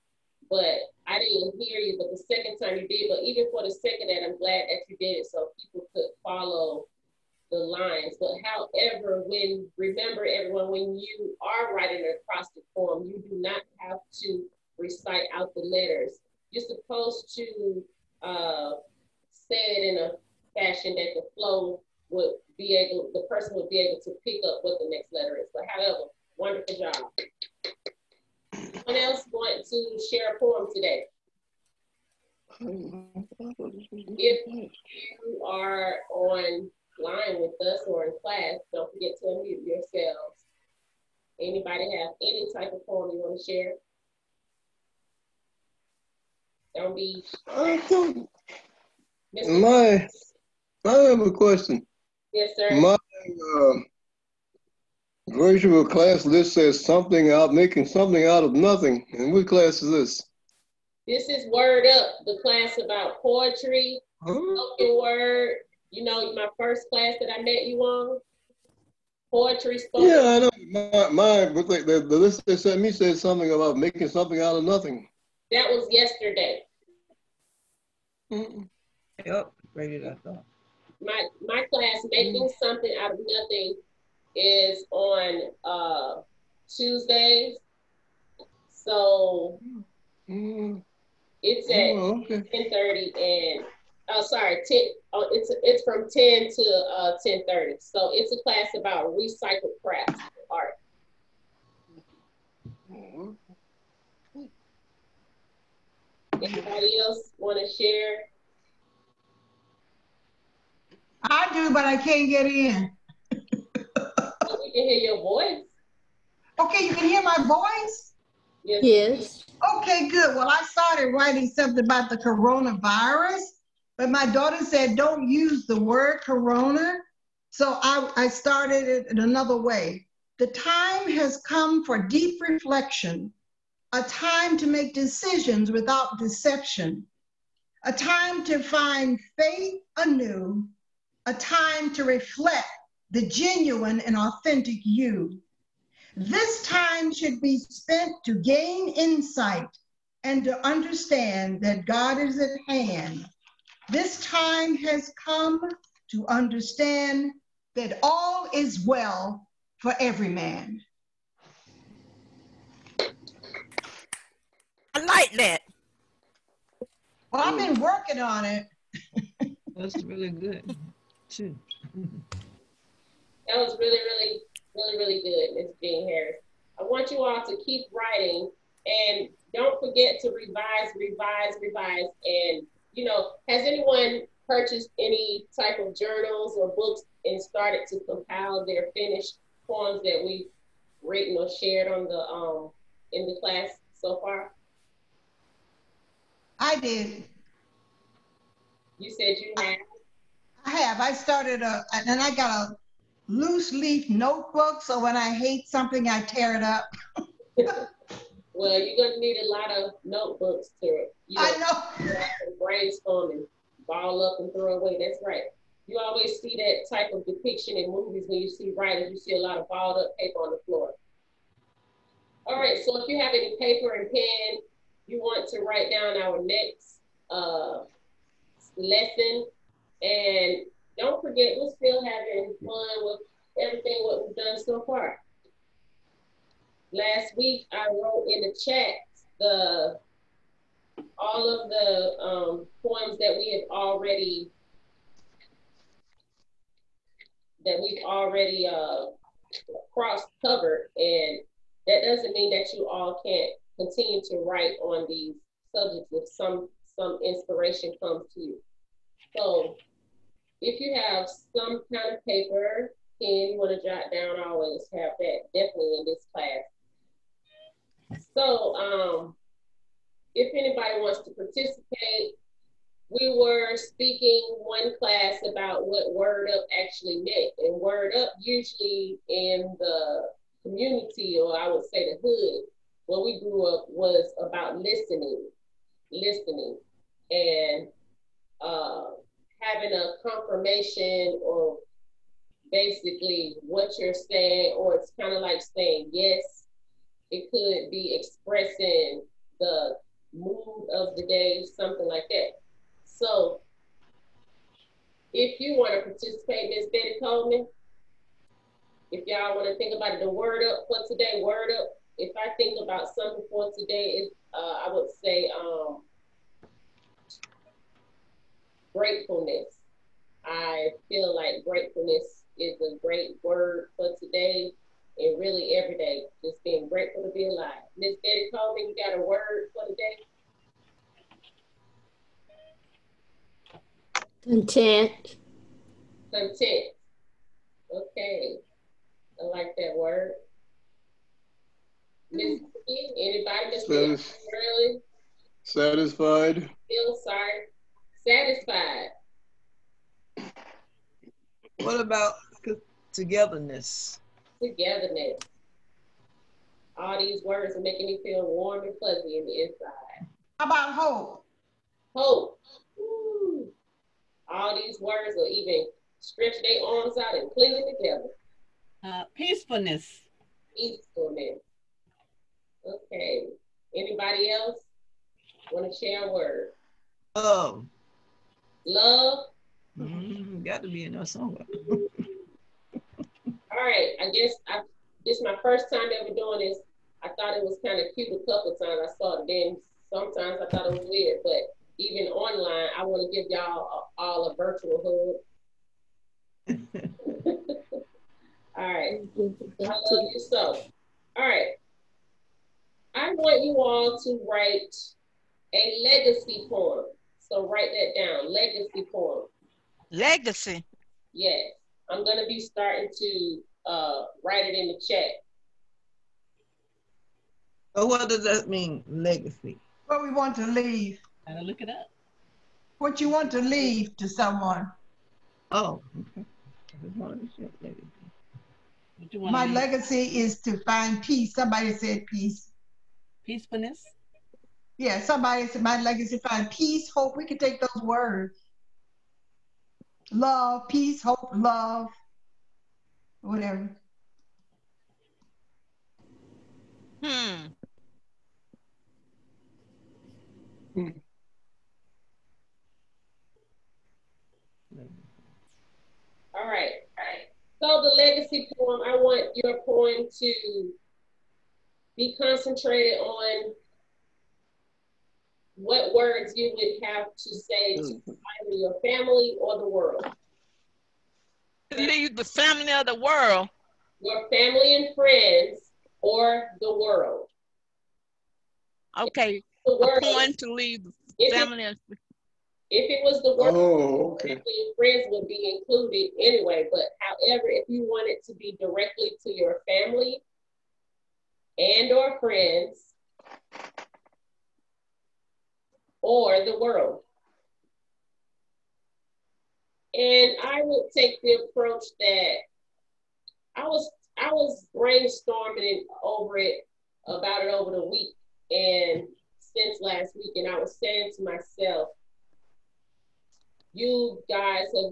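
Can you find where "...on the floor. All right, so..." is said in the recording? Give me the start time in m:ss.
3:40.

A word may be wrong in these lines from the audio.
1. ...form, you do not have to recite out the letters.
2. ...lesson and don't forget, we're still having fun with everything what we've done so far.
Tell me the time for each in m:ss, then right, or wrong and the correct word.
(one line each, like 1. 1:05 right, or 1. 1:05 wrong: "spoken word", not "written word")
1. 0:12 right
2. 3:48 right.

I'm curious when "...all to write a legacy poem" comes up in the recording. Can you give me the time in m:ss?
6:43.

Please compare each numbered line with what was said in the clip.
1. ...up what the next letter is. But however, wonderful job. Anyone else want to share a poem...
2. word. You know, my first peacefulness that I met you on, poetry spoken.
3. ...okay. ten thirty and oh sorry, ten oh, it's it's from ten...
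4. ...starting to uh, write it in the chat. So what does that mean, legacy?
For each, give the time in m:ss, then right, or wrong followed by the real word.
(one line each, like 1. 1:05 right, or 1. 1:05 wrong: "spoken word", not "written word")
1. 0:24 right
2. 1:05 wrong: "class", not "peacefulness"
3. 1:32 right
4. 6:52 right.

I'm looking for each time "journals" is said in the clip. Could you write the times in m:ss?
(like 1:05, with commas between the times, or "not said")
3:05.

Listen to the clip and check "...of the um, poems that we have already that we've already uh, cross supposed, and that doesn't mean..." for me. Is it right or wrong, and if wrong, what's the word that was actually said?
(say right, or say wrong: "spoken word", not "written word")
wrong: "covered", not "supposed".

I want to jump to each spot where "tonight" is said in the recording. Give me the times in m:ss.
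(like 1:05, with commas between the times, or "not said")
not said.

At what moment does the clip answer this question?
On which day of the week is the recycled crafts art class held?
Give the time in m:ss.
1:26.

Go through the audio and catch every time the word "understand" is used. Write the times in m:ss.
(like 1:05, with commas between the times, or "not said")
2:30, 2:36.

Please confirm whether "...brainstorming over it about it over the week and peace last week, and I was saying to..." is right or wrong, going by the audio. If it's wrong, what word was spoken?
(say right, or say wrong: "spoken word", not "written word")
wrong: "since", not "peace".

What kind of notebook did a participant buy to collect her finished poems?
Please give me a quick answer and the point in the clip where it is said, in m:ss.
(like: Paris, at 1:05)
loose leaf notebook, at 3:23.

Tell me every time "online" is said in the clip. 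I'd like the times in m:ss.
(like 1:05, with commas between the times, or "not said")
0:36, 6:32.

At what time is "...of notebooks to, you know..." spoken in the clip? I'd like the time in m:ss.
3:29.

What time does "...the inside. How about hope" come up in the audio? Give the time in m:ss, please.
5:59.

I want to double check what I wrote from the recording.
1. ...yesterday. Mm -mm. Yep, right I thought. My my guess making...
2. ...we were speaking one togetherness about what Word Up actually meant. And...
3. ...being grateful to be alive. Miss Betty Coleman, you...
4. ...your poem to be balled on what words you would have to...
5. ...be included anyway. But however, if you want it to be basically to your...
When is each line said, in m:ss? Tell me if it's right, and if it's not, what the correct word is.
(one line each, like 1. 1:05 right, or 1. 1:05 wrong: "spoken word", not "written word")
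1. 1:15 wrong: "class", not "guess"
2. 4:33 wrong: "class", not "togetherness"
3. 5:26 right
4. 7:39 wrong: "concentrated", not "balled"
5. 8:05 wrong: "directly", not "basically".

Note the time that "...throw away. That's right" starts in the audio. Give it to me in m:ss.
3:34.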